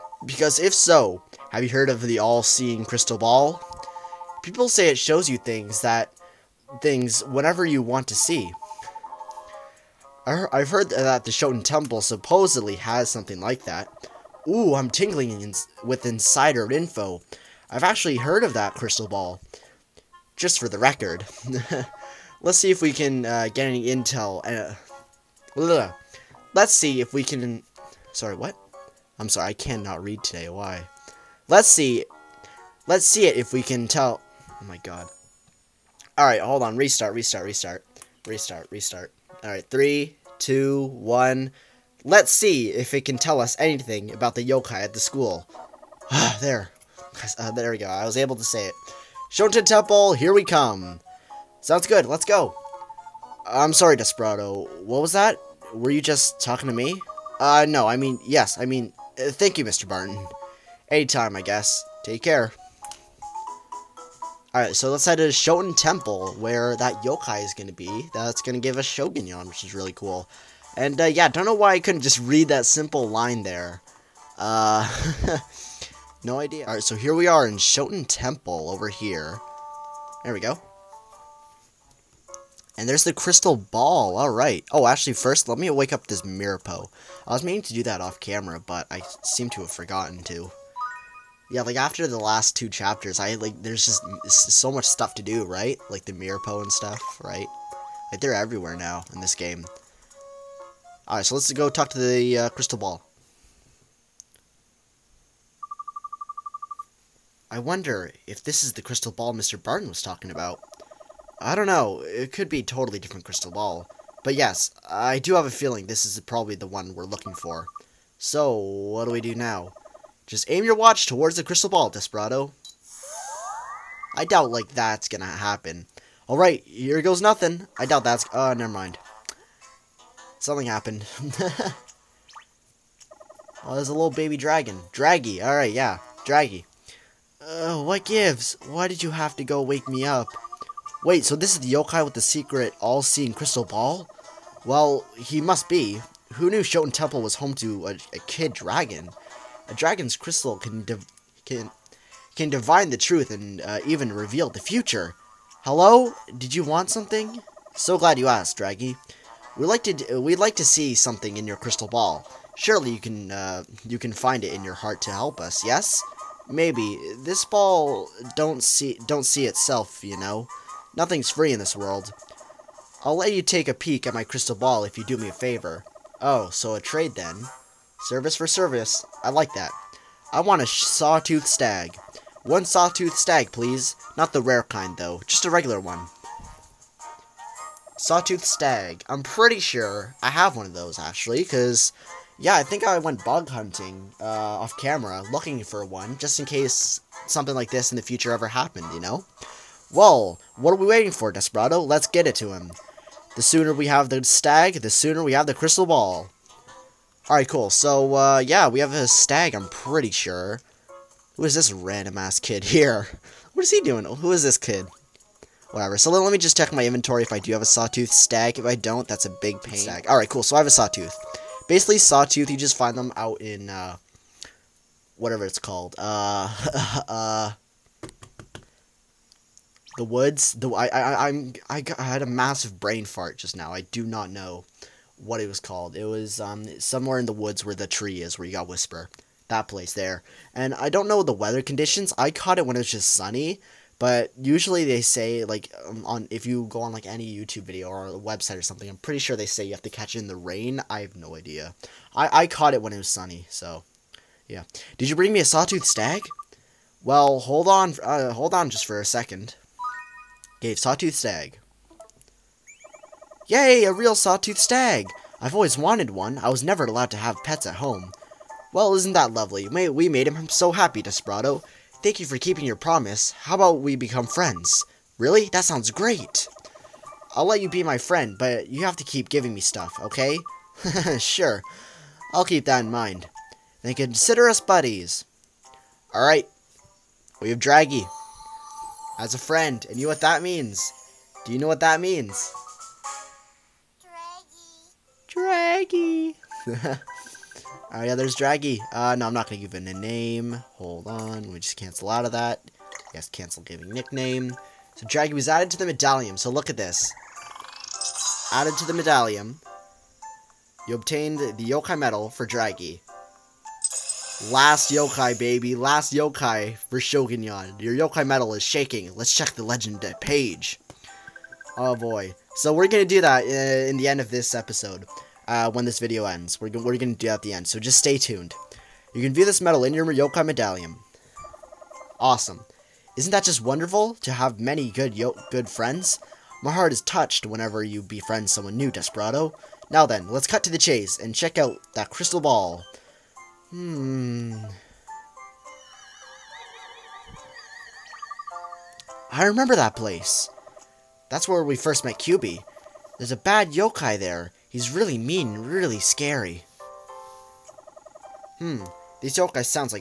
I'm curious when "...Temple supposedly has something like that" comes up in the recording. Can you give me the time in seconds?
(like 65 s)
11 s.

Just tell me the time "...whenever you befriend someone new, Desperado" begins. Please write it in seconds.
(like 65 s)
337 s.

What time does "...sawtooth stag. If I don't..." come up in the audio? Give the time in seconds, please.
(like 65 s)
217 s.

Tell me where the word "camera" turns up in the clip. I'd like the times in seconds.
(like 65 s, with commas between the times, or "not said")
88 s, 194 s.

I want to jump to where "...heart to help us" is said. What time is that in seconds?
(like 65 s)
164 s.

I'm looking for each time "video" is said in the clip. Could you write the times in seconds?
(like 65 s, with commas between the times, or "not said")
247 s, 325 s.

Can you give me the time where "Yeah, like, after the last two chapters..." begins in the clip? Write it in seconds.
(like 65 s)
91 s.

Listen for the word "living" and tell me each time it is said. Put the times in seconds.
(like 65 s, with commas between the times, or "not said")
not said.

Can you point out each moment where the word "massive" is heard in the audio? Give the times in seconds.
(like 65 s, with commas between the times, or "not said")
232 s.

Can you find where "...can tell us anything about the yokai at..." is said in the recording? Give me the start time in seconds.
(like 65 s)
43 s.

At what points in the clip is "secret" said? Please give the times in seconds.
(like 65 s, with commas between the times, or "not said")
142 s.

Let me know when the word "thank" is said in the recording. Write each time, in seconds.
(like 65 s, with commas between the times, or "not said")
59 s, 272 s.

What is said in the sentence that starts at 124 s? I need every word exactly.
I doubt, like, that's gonna happen.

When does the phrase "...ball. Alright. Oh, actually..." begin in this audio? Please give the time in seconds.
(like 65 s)
83 s.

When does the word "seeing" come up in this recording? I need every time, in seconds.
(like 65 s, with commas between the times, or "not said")
2 s, 142 s.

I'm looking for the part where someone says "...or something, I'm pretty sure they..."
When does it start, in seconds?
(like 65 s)
248 s.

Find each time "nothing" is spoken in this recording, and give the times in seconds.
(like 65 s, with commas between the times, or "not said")
127 s, 170 s.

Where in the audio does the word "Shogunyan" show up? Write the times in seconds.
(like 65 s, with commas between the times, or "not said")
68 s, 317 s.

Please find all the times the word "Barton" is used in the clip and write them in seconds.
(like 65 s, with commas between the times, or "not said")
59 s, 109 s.